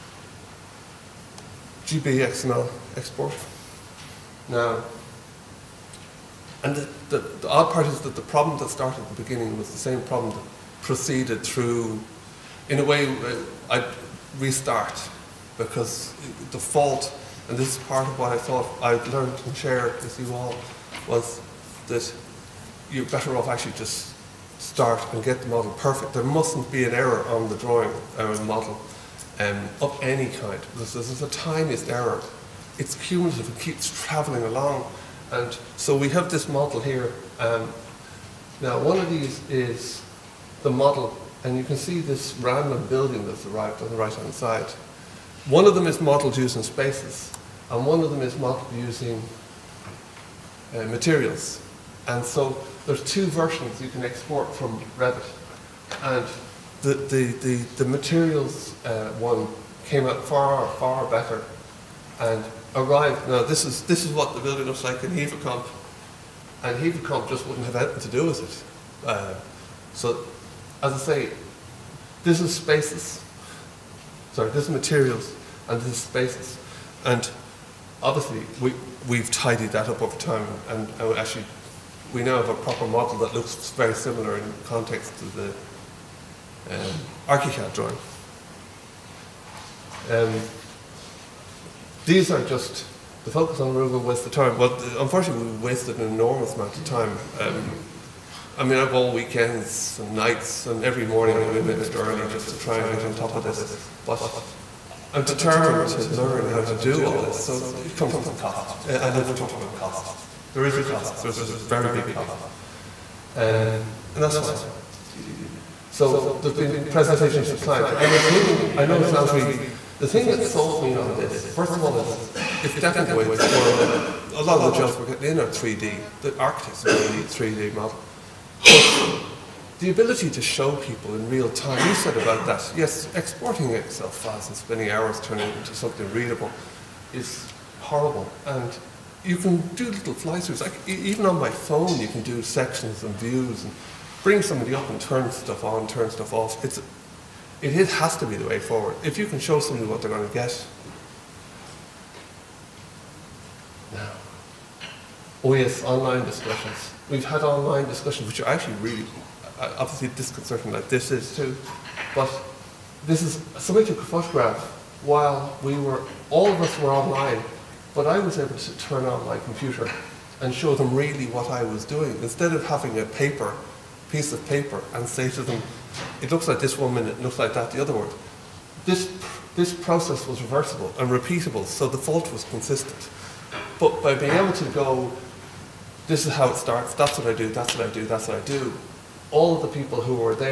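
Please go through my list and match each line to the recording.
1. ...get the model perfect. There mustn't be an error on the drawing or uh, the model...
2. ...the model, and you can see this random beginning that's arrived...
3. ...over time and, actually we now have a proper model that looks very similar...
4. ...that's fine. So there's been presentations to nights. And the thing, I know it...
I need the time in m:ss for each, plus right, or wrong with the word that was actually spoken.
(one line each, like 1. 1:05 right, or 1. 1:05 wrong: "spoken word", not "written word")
1. 0:25 right
2. 0:40 wrong: "building", not "beginning"
3. 1:20 right
4. 1:54 wrong: "clients", not "nights".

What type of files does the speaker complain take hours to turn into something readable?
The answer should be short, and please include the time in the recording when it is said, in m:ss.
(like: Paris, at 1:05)
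Excel files, at 2:13.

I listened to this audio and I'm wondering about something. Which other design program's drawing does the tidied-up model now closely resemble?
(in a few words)
ArchiCAD.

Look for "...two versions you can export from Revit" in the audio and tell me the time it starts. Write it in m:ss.
0:53.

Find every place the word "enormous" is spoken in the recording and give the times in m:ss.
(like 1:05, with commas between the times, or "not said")
1:36.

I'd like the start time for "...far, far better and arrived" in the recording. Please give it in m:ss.
1:00.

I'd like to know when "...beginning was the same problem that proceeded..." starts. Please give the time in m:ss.
0:09.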